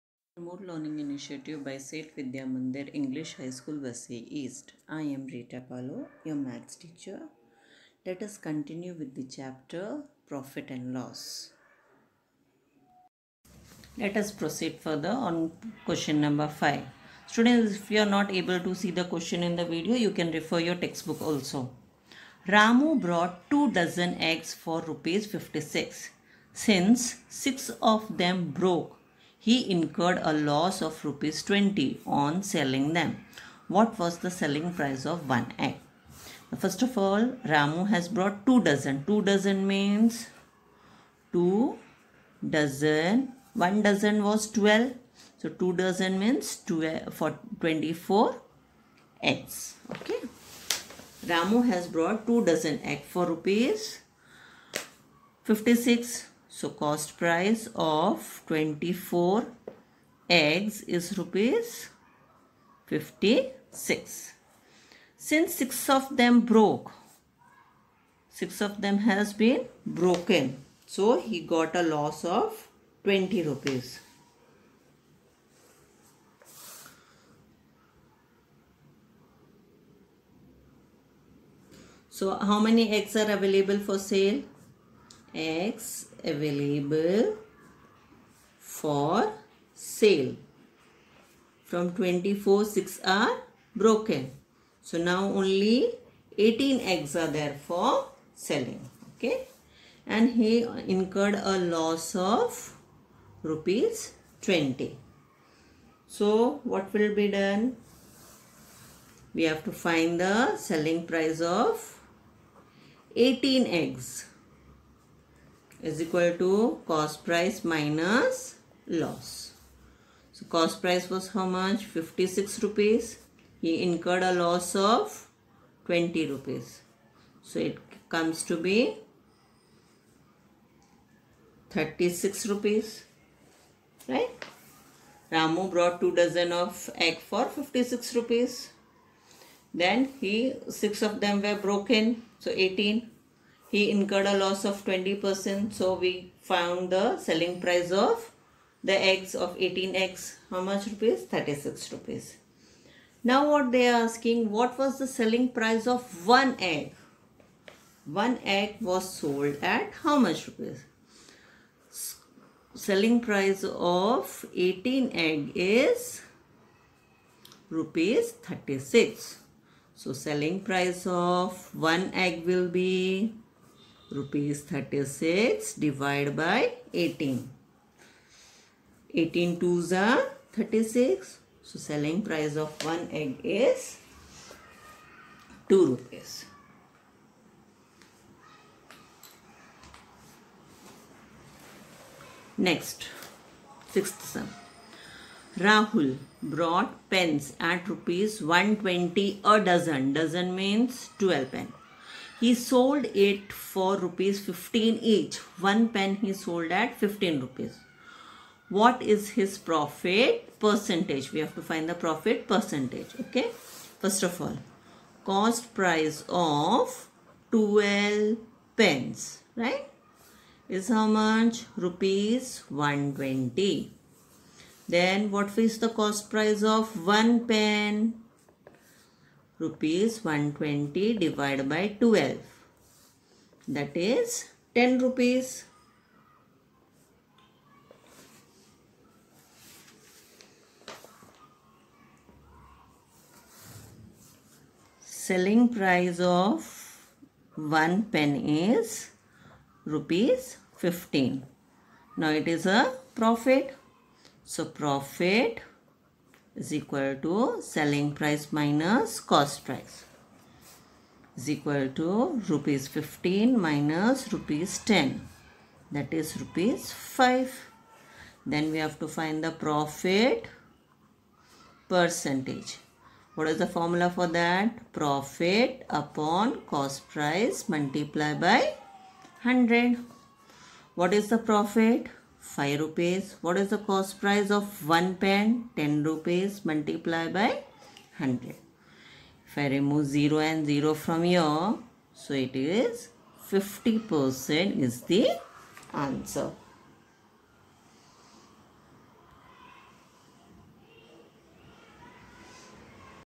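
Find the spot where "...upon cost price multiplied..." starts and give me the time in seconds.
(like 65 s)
275 s.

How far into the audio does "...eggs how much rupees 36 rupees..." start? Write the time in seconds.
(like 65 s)
149 s.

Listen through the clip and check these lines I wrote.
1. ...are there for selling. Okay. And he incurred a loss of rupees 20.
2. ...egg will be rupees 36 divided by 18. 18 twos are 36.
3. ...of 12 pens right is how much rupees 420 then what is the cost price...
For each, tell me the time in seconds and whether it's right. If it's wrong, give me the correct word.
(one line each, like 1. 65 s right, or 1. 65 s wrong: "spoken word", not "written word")
1. 97 s right
2. 172 s right
3. 216 s wrong: "120", not "420".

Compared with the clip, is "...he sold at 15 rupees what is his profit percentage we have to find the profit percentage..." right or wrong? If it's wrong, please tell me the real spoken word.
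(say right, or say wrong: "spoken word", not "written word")
right.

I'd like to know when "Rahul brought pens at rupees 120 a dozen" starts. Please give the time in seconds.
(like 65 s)
195 s.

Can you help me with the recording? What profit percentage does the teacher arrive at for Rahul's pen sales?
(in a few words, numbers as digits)
50%.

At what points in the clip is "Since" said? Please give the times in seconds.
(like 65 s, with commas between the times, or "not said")
26 s, 65 s.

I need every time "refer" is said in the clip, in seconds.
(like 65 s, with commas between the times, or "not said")
20 s.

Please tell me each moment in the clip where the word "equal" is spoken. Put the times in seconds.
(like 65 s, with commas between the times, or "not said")
116 s, 256 s, 261 s.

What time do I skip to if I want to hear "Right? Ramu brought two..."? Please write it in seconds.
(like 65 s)
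134 s.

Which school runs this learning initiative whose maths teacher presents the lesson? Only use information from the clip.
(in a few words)
Seth Vidya Mandir English High School.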